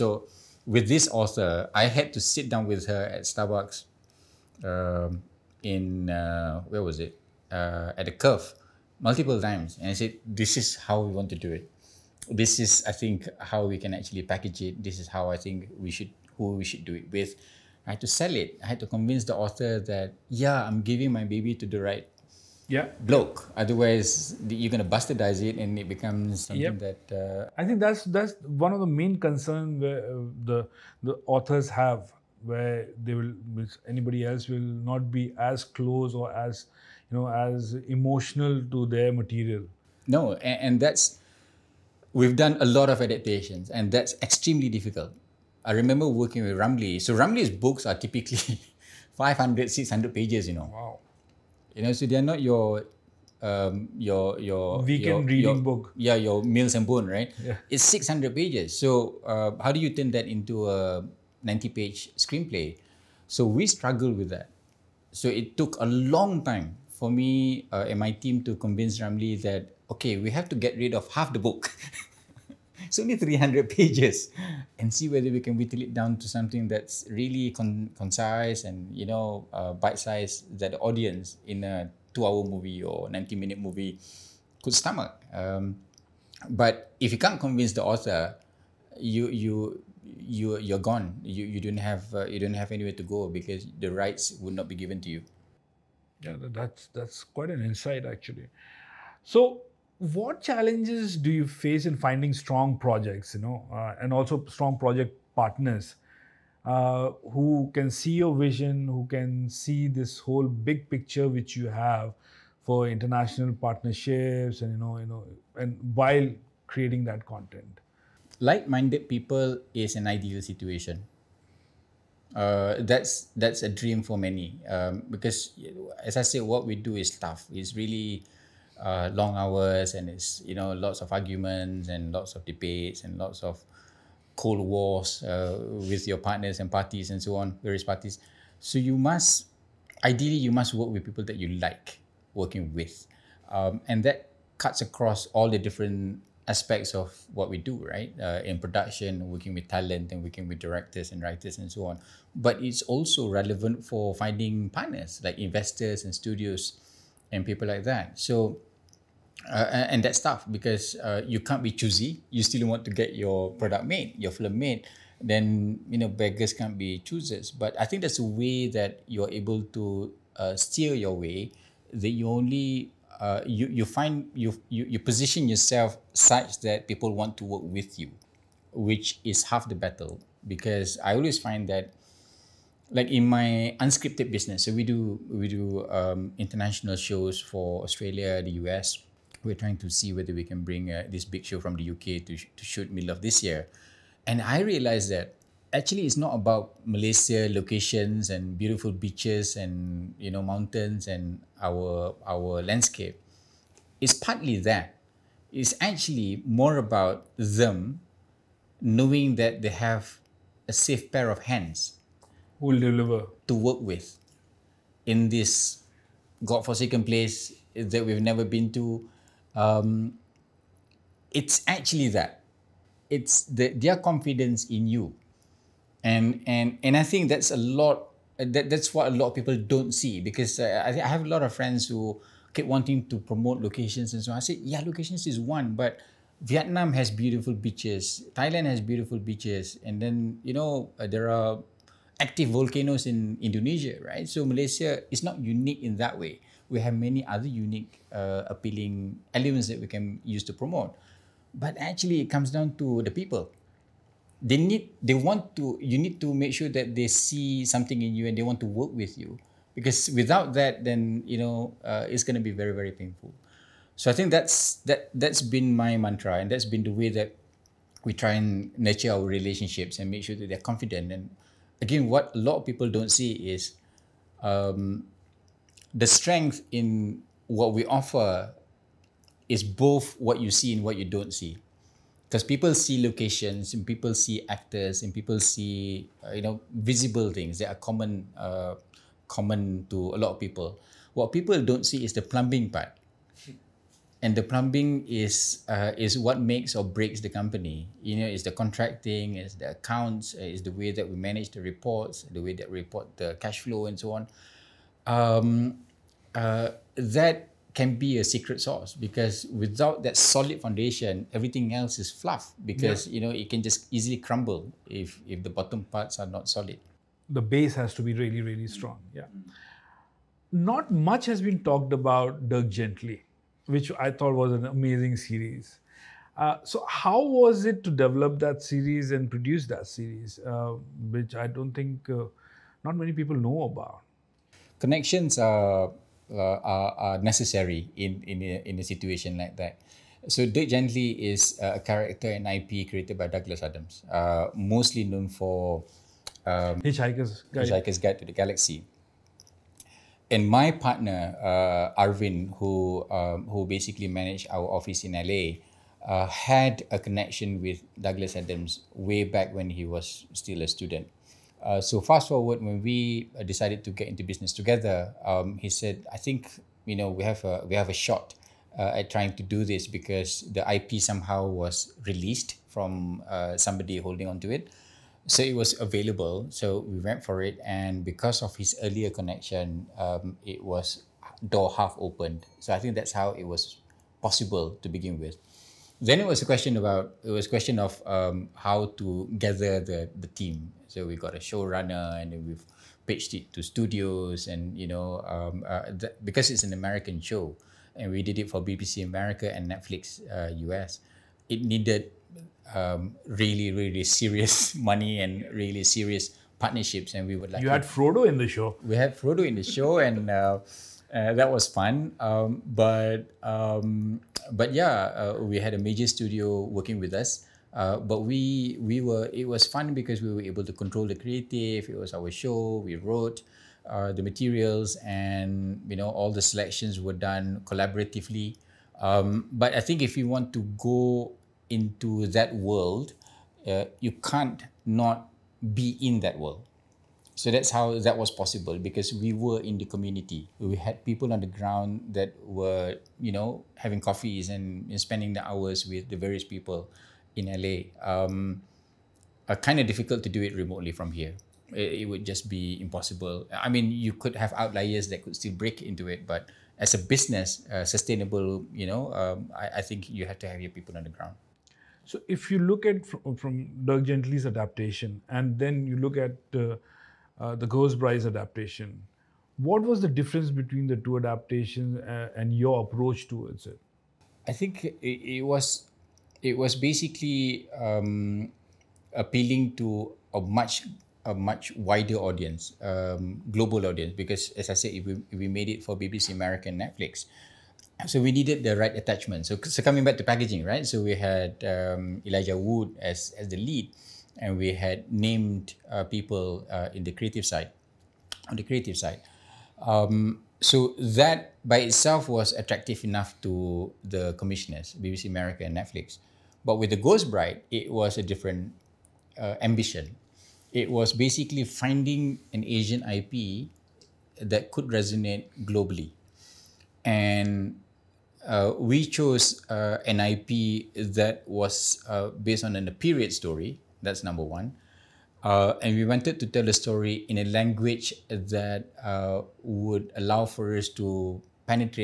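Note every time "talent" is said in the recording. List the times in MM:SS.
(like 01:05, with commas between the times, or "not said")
02:29.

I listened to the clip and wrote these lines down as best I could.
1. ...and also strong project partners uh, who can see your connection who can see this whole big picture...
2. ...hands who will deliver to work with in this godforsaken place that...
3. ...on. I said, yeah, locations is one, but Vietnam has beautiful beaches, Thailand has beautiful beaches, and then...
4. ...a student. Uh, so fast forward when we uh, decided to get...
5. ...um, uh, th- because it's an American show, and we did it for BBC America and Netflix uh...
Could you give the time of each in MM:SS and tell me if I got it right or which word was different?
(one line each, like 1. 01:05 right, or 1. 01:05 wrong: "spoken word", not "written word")
1. 01:44 wrong: "vision", not "connection"
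2. 03:31 right
3. 03:54 right
4. 06:00 right
5. 06:35 right.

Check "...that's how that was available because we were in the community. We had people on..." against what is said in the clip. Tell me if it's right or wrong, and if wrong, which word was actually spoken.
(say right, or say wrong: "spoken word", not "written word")
wrong: "possible", not "available".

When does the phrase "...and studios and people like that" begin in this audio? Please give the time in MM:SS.
02:36.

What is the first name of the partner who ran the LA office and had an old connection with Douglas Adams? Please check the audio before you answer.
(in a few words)
Arvin.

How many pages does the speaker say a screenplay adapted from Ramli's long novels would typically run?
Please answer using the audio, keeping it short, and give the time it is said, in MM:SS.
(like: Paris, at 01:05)
90, at 01:01.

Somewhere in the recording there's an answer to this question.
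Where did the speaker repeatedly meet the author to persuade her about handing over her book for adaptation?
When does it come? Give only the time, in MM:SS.
00:03.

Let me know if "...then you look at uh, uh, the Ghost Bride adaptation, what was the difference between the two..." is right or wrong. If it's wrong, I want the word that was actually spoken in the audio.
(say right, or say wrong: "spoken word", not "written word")
right.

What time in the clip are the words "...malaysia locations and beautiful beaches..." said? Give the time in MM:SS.
03:16.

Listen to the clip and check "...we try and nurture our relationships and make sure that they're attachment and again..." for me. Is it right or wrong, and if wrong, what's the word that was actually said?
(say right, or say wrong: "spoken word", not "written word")
wrong: "confident", not "attachment".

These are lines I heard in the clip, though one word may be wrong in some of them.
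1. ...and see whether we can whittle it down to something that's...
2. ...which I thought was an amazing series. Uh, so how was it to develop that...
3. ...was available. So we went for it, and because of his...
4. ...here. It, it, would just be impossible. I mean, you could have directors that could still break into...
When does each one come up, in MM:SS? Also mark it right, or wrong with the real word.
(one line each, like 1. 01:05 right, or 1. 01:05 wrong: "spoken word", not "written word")
1. 01:14 right
2. 05:23 right
3. 06:15 right
4. 07:31 wrong: "outliers", not "directors".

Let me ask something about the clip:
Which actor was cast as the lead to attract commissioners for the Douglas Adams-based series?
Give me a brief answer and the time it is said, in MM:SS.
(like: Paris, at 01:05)
Elijah Wood, at 08:12.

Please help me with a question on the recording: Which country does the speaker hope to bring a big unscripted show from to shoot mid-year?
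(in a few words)
UK.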